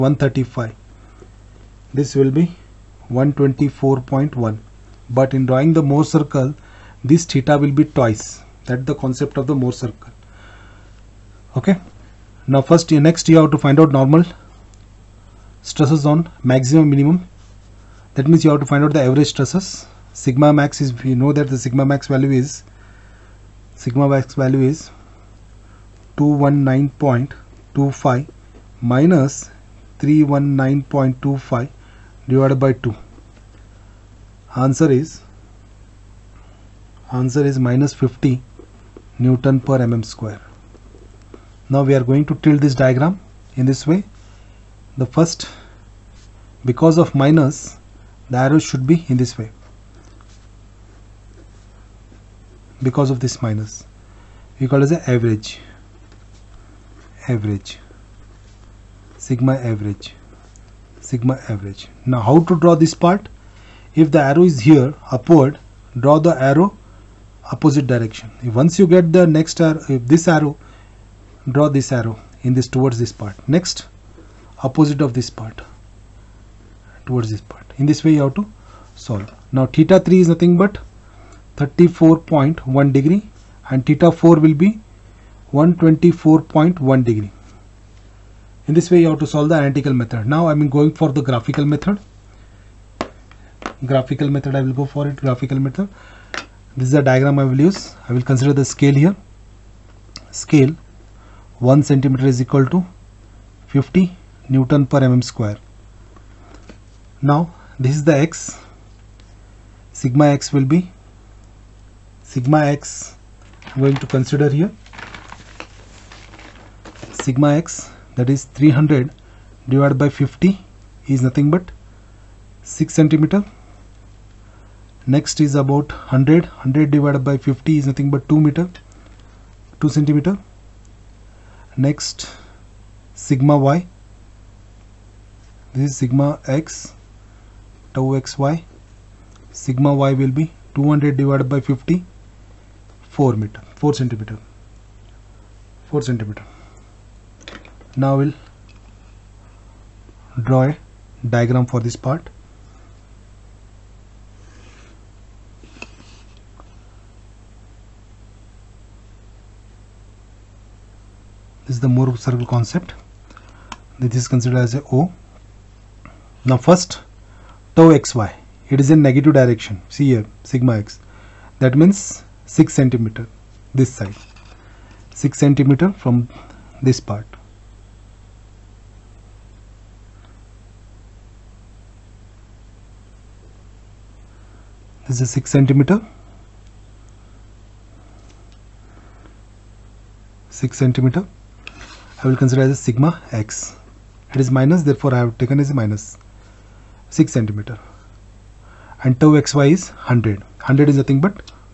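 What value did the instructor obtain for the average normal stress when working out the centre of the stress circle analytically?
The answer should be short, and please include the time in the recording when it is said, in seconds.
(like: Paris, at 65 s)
-50 N/mm², at 37 s.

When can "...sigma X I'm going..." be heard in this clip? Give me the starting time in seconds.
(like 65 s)
112 s.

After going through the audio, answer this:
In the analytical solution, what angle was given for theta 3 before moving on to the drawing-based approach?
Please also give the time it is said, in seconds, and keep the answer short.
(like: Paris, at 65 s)
34.1 degrees, at 81 s.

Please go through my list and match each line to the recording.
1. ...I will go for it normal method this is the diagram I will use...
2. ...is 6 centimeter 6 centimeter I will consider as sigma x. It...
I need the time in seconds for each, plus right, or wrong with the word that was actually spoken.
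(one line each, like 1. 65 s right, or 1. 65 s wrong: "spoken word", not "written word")
1. 94 s wrong: "graphical", not "normal"
2. 185 s right.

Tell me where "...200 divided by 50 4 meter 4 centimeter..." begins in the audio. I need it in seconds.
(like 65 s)
140 s.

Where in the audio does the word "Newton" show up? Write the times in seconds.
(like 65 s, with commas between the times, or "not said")
39 s, 104 s.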